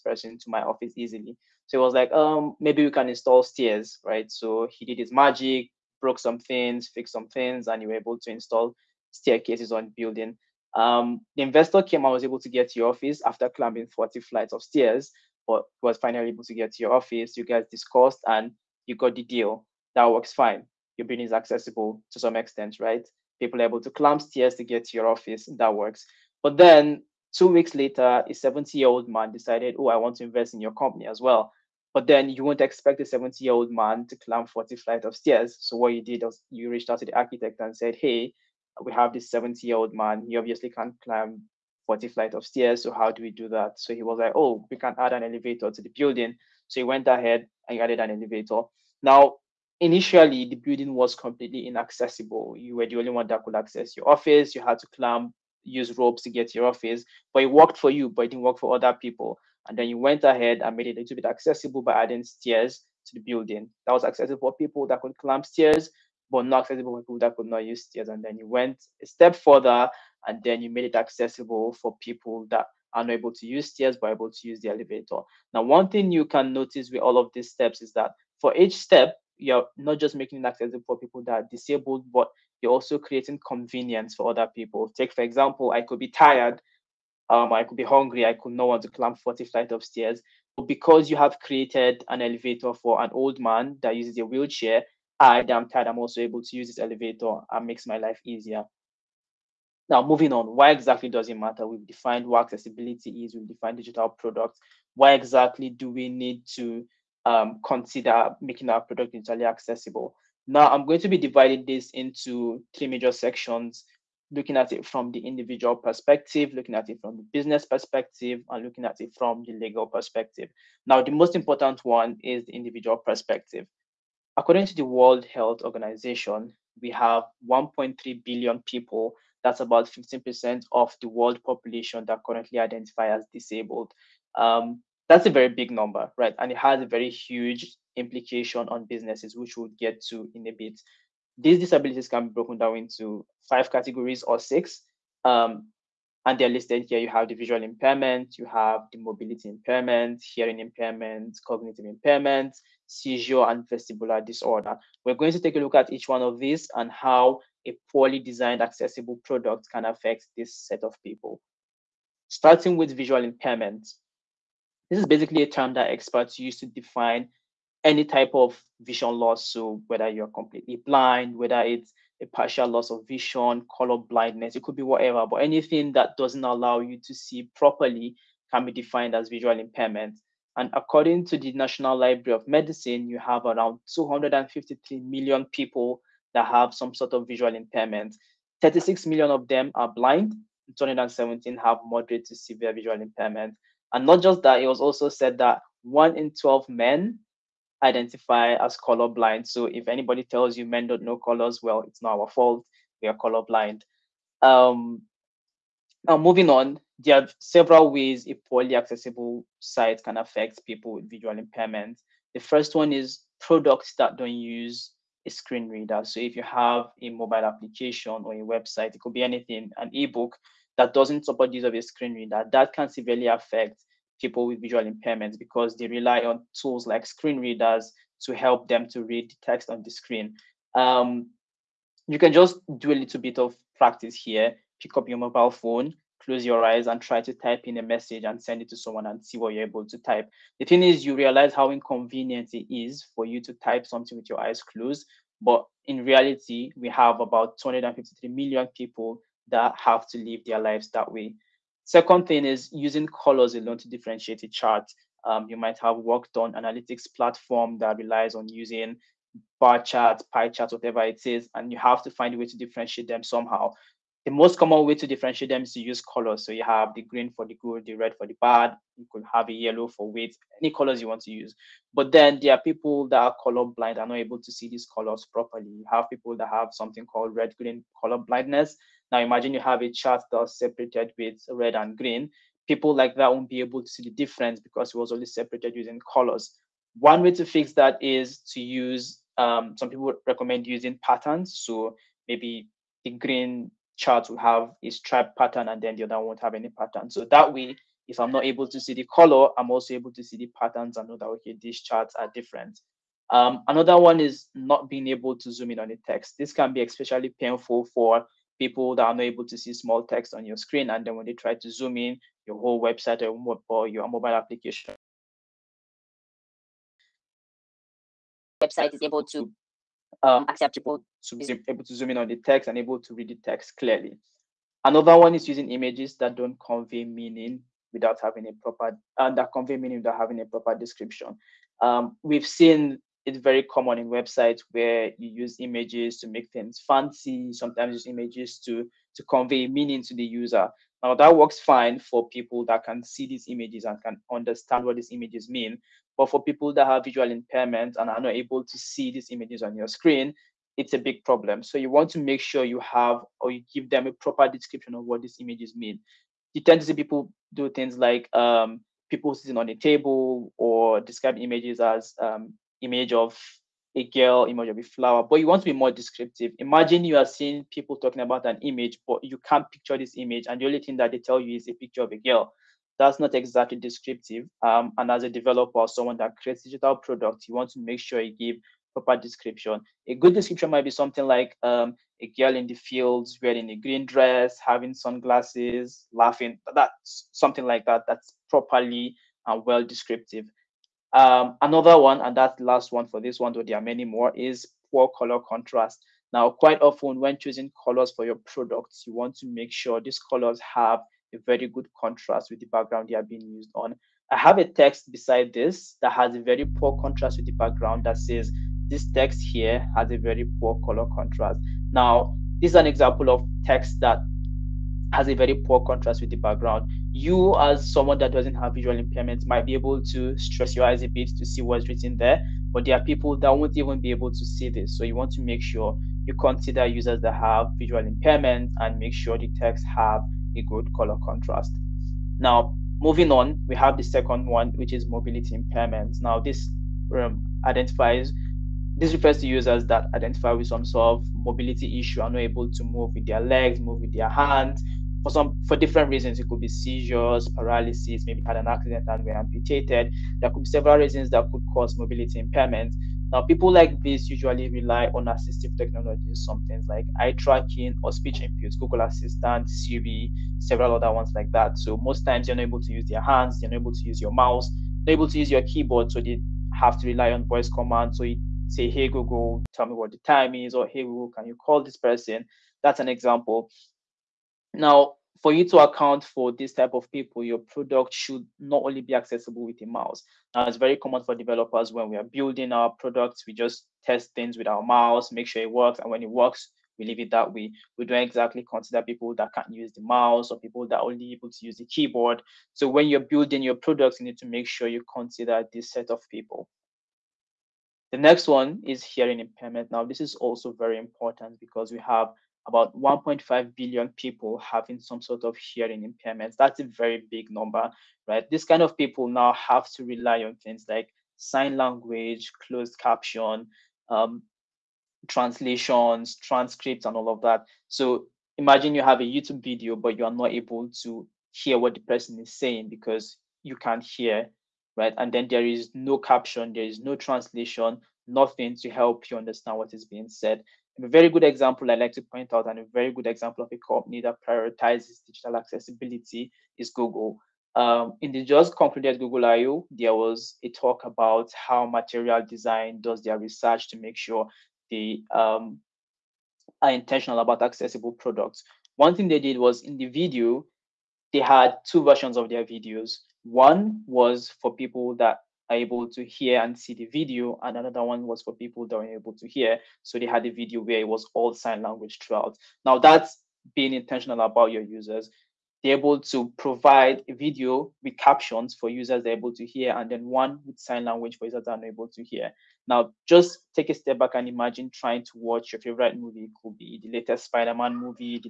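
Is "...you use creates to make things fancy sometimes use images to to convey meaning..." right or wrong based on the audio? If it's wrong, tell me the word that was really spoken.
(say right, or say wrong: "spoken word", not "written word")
wrong: "images", not "creates".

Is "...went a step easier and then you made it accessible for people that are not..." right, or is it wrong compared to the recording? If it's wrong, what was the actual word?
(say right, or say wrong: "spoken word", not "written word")
wrong: "further", not "easier".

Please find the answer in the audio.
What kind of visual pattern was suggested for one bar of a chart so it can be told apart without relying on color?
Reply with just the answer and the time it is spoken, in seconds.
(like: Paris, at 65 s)
stripe pattern, at 294 s.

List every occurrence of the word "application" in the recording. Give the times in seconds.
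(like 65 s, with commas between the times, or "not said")
217 s, 314 s.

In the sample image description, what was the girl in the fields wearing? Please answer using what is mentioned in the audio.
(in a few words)
green dress.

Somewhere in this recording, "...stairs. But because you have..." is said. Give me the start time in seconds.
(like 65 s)
89 s.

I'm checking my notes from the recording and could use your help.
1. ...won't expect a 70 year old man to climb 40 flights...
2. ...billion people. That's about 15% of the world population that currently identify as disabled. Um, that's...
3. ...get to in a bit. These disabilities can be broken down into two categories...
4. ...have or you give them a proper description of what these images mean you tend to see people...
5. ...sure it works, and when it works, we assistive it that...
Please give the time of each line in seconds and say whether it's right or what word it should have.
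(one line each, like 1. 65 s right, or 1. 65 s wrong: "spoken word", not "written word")
1. 32 s right
2. 128 s right
3. 139 s wrong: "five", not "two"
4. 352 s right
5. 485 s wrong: "leave", not "assistive".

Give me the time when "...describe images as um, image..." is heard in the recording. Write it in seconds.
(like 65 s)
361 s.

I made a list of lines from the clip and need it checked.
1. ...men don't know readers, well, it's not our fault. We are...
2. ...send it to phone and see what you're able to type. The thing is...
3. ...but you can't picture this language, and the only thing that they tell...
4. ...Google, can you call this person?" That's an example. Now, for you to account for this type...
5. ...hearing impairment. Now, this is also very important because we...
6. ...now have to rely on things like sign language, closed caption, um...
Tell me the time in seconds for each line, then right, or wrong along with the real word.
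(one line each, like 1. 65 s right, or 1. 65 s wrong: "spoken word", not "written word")
1. 200 s wrong: "colors", not "readers"
2. 238 s wrong: "someone", not "phone"
3. 369 s wrong: "image", not "language"
4. 471 s right
5. 499 s right
6. 509 s right.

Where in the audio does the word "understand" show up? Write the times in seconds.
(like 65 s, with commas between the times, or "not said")
344 s, 529 s.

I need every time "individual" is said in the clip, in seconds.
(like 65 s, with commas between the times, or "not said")
115 s, 122 s.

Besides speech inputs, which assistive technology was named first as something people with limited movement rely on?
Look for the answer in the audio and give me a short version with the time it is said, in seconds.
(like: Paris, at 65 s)
eye tracking, at 457 s.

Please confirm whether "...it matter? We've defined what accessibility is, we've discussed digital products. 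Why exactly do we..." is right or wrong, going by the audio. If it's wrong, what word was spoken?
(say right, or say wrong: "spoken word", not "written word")
wrong: "defined", not "discussed".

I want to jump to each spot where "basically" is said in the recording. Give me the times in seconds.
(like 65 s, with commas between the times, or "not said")
165 s.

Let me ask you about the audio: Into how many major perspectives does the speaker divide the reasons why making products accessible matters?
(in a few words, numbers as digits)
3.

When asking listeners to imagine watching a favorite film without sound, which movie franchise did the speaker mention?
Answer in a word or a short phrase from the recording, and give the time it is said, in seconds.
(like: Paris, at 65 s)
Spider-Man, at 577 s.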